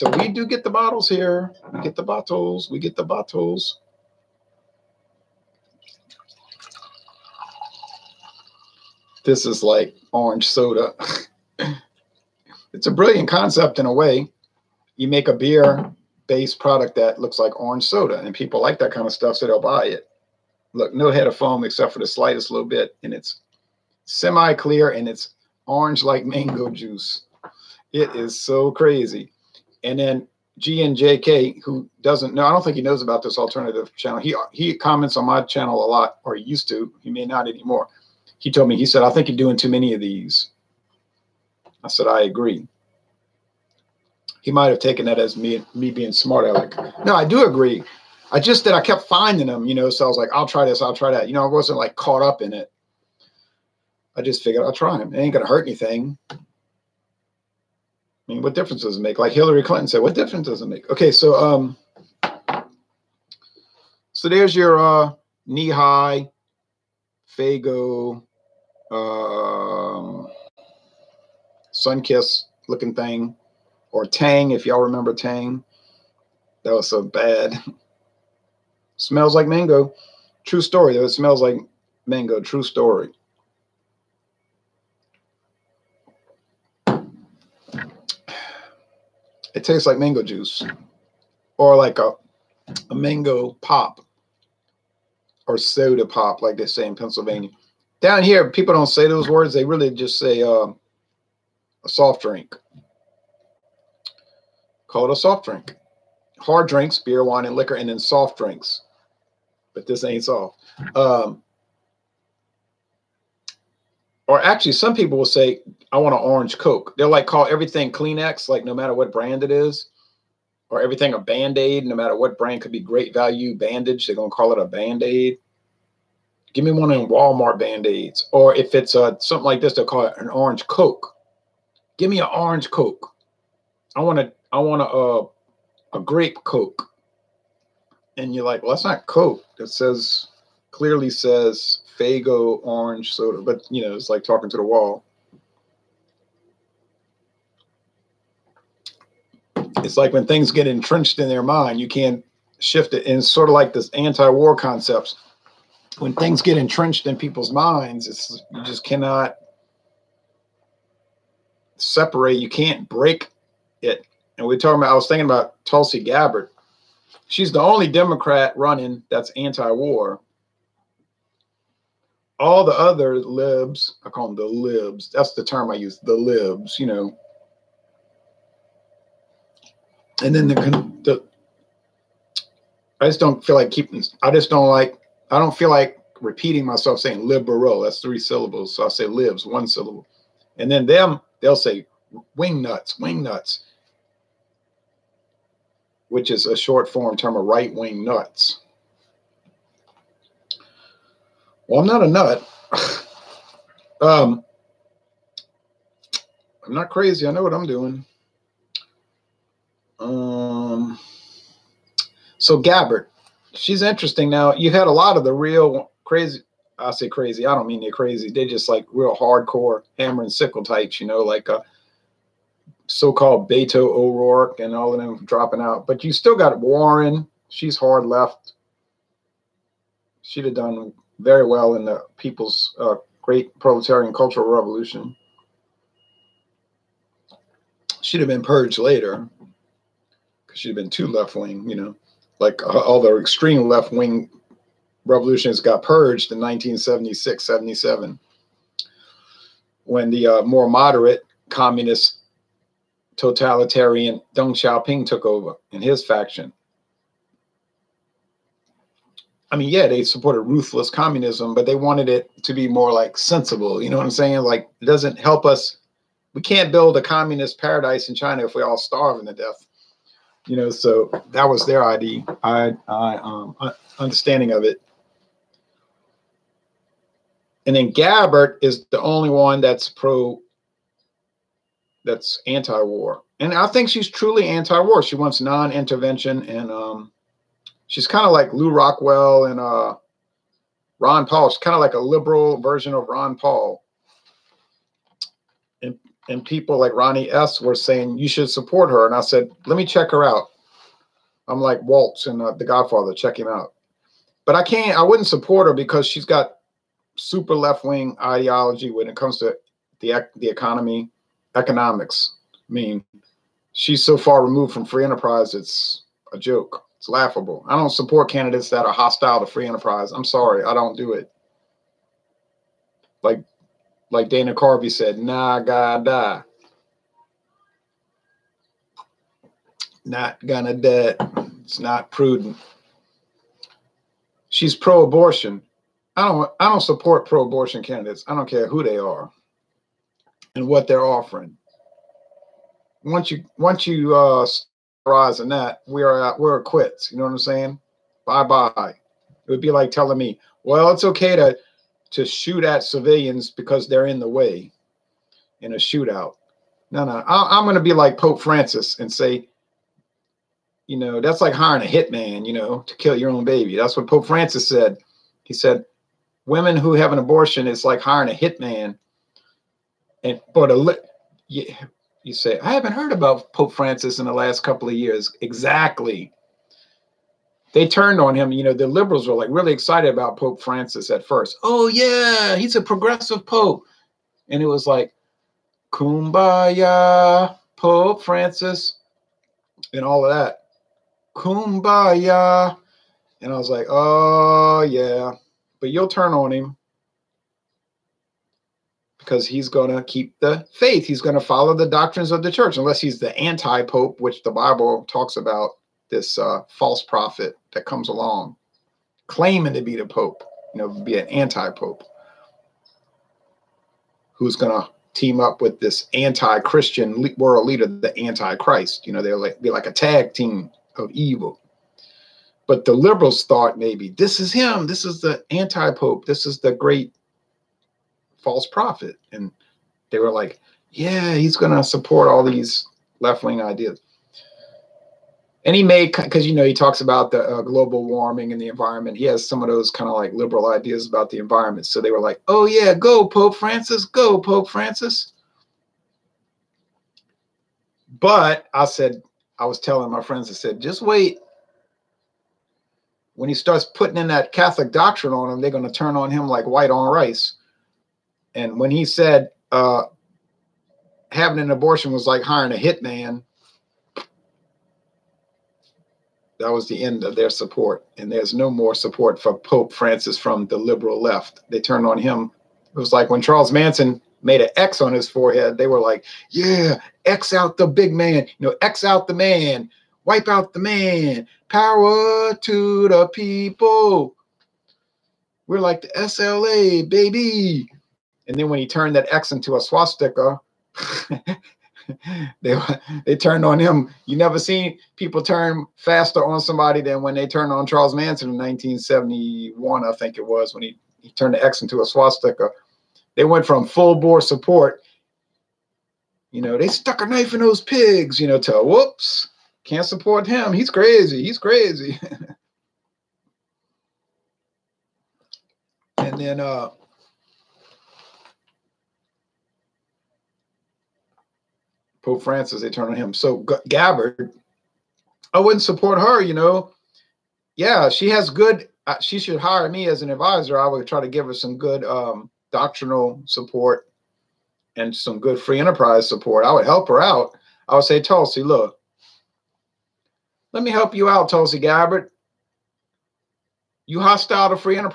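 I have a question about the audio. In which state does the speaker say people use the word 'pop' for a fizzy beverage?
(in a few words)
Pennsylvania.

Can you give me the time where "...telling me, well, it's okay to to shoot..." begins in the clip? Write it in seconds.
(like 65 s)
349 s.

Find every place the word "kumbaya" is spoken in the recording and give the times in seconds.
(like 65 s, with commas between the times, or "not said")
385 s, 391 s.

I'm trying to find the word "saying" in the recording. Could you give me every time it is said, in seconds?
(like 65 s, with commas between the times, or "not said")
187 s, 264 s, 297 s, 347 s.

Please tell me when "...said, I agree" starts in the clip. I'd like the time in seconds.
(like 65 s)
41 s.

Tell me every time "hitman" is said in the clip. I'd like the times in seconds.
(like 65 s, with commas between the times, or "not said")
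361 s, 368 s, 462 s.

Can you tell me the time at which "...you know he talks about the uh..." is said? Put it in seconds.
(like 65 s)
436 s.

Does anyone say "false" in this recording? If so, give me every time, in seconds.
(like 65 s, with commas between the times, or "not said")
406 s, 428 s.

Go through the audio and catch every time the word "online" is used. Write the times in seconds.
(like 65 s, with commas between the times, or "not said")
not said.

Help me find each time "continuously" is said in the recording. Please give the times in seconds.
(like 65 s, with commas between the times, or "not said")
not said.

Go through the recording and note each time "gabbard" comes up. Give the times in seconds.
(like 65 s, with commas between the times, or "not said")
166 s, 212 s, 277 s, 523 s, 541 s.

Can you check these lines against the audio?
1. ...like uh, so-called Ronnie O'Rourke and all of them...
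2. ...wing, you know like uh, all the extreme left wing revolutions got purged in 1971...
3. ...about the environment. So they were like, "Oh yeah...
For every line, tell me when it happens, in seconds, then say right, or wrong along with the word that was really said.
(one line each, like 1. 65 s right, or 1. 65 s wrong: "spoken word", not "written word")
1. 221 s wrong: "Beto", not "Ronnie"
2. 241 s wrong: "1976", not "1971"
3. 441 s right.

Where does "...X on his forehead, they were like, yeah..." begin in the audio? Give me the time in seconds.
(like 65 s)
474 s.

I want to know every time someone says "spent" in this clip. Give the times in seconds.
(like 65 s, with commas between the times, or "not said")
not said.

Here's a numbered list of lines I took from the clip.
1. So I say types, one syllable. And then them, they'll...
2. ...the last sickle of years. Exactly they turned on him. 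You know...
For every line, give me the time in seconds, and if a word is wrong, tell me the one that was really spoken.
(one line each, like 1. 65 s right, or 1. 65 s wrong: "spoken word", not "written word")
1. 188 s wrong: "lives", not "types"
2. 374 s wrong: "couple", not "sickle".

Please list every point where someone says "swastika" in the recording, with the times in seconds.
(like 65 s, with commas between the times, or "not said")
489 s, 502 s.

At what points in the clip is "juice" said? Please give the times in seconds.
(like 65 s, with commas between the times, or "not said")
26 s, 90 s.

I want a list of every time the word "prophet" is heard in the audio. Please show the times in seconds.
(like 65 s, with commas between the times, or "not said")
407 s, 428 s.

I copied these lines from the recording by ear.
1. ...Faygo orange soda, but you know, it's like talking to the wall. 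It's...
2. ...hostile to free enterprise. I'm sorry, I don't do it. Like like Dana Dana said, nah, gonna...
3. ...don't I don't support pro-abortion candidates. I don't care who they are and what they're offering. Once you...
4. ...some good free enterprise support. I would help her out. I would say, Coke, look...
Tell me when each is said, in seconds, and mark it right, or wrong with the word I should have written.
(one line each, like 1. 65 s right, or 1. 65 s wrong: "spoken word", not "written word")
1. 141 s right
2. 318 s wrong: "Carvey", not "Dana"
3. 336 s right
4. 535 s wrong: "Tulsi", not "Coke".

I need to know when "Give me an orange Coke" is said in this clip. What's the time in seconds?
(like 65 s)
131 s.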